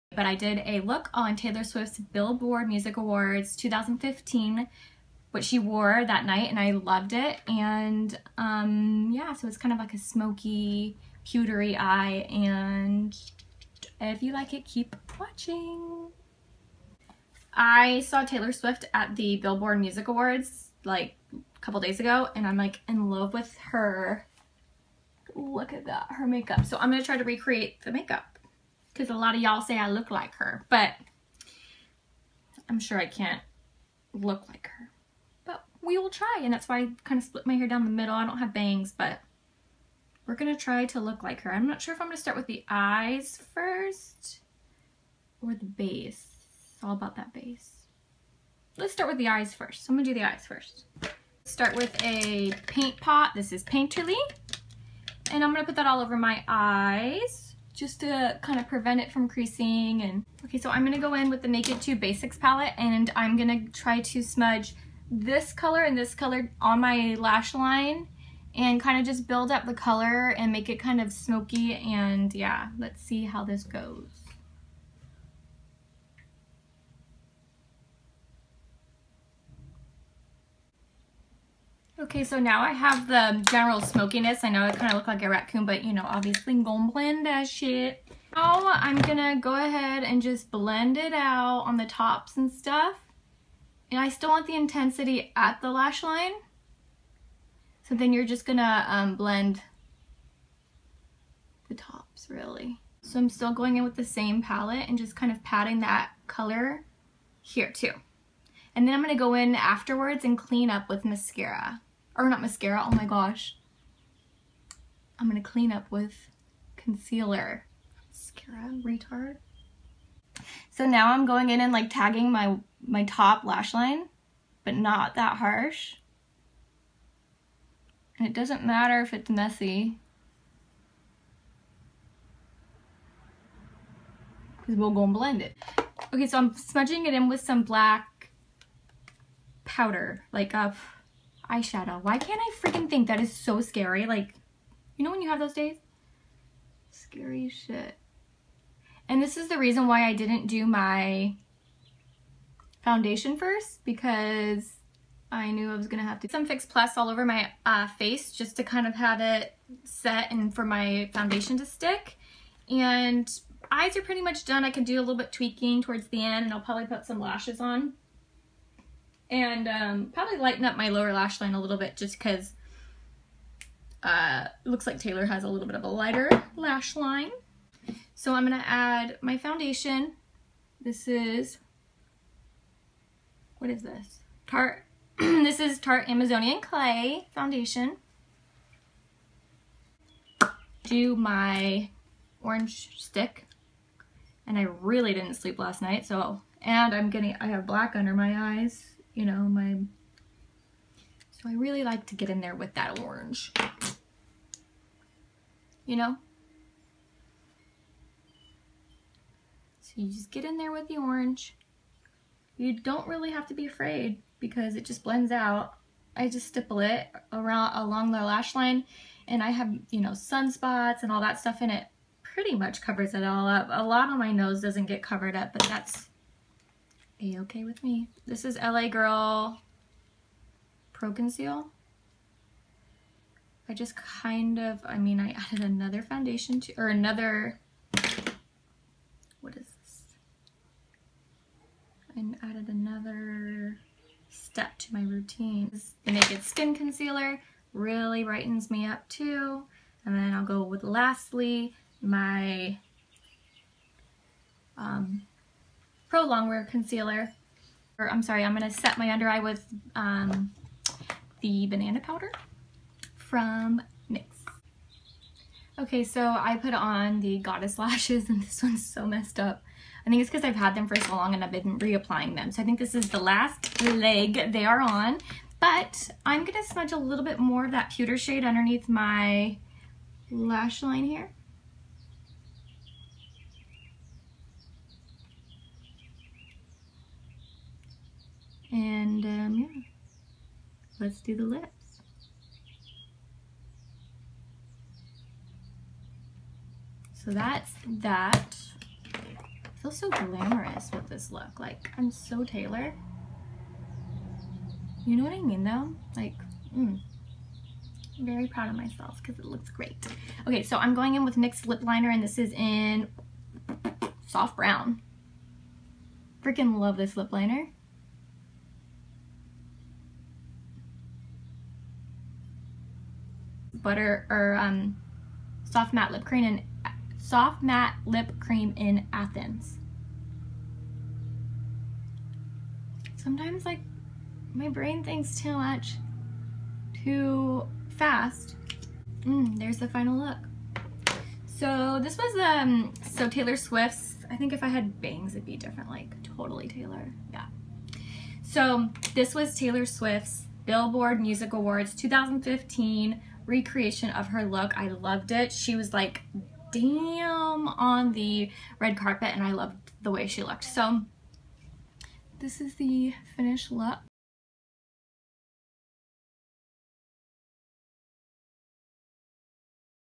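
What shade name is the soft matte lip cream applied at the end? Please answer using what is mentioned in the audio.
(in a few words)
Athens.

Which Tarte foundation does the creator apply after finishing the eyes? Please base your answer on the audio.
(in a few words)
Amazonian Clay Foundation.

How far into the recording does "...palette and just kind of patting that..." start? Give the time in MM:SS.
01:44.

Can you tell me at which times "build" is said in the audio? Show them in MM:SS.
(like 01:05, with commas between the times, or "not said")
01:09.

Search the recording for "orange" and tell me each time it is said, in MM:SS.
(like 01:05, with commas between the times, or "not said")
03:12, 03:22, 03:30.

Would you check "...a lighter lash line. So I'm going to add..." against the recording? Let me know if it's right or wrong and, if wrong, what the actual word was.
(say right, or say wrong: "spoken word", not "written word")
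right.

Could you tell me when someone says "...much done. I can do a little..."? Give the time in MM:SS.
02:44.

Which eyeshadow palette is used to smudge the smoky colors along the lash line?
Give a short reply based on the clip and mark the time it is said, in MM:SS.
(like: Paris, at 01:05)
Naked 2 Basics, at 01:01.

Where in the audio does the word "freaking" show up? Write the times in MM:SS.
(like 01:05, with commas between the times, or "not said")
02:22, 05:16.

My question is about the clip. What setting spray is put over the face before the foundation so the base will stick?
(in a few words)
Fix Plus.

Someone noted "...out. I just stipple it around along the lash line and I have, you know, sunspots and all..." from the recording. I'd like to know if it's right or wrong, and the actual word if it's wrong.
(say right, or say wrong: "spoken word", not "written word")
right.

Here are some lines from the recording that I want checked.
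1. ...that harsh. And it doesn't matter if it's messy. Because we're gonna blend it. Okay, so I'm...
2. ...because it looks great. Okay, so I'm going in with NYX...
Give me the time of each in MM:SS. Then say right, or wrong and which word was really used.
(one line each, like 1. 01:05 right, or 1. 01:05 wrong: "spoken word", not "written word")
1. 02:05 right
2. 05:09 right.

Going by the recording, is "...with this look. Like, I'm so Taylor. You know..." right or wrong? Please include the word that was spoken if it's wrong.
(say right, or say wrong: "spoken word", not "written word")
right.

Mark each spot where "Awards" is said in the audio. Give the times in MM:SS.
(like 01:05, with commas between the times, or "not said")
00:02, 00:20, 05:51.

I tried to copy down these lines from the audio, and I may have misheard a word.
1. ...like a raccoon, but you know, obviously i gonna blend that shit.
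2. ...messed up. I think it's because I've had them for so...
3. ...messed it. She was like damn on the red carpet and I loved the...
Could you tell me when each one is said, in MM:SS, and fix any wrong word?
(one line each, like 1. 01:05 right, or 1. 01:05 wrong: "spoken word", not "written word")
1. 01:25 right
2. 04:29 right
3. 05:54 wrong: "loved", not "messed".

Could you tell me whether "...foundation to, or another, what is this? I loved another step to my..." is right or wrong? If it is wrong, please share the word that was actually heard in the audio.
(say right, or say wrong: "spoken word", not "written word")
wrong: "added", not "loved".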